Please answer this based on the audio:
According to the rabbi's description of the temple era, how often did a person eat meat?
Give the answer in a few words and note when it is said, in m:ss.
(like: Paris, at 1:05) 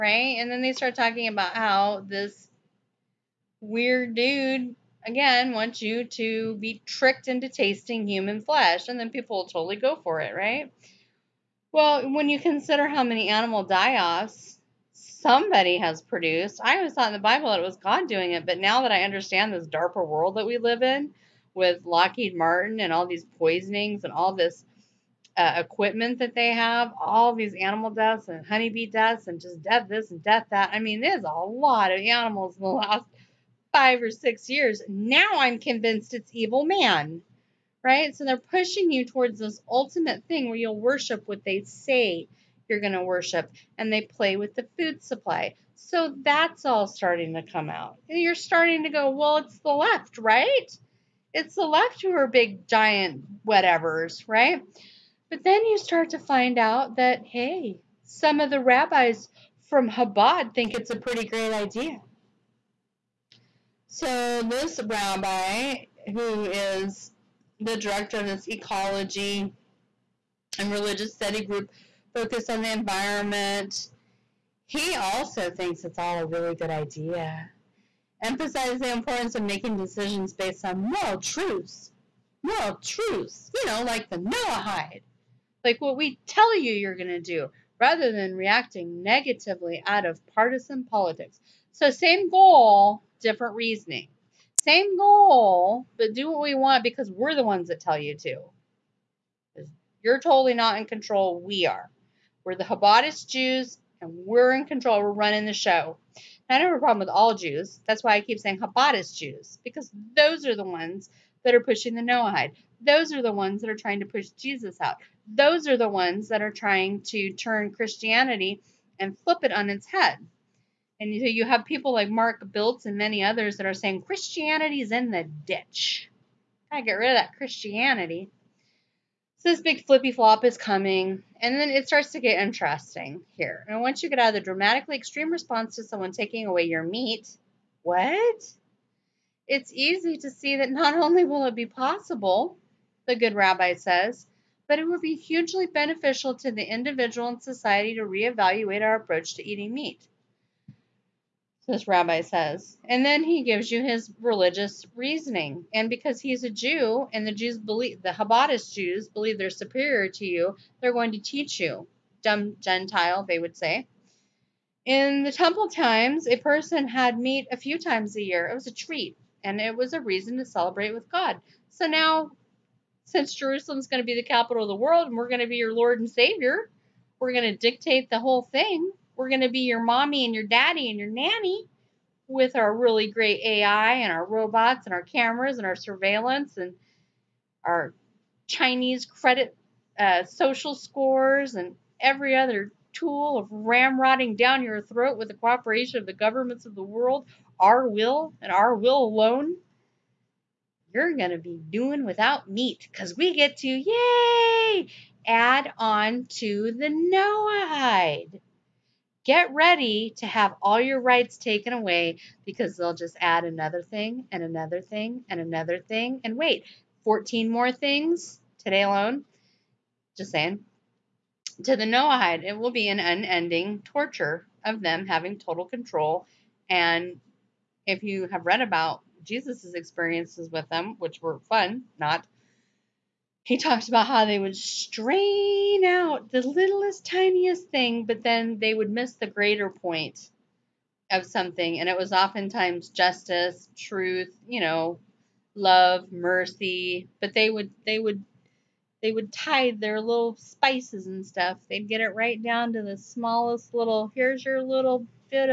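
a few times a year, at 2:47.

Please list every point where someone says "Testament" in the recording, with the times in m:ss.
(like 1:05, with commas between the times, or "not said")
not said.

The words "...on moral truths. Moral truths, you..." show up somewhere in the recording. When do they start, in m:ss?
1:20.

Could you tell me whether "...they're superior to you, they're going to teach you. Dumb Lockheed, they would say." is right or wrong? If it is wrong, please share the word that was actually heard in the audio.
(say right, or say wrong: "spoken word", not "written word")
wrong: "Gentile", not "Lockheed".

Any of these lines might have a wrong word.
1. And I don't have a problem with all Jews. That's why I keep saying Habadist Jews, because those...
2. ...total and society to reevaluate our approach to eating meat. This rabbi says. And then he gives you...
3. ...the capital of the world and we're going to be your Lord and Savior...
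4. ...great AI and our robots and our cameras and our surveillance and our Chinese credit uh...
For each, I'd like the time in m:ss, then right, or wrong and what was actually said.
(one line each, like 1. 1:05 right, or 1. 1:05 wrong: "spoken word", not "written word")
1. 1:46 right
2. 2:26 wrong: "individual", not "total"
3. 2:54 right
4. 3:03 right.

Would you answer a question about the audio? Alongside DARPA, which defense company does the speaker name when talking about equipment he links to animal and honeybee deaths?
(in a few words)
Lockheed Martin.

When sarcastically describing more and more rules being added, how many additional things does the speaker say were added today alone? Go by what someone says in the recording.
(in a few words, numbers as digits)
14.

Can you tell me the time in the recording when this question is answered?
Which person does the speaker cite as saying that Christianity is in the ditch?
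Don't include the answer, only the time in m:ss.
2:02.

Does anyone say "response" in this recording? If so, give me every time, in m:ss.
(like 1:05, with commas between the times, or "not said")
2:15.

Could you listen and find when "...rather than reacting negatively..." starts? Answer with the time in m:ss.
1:27.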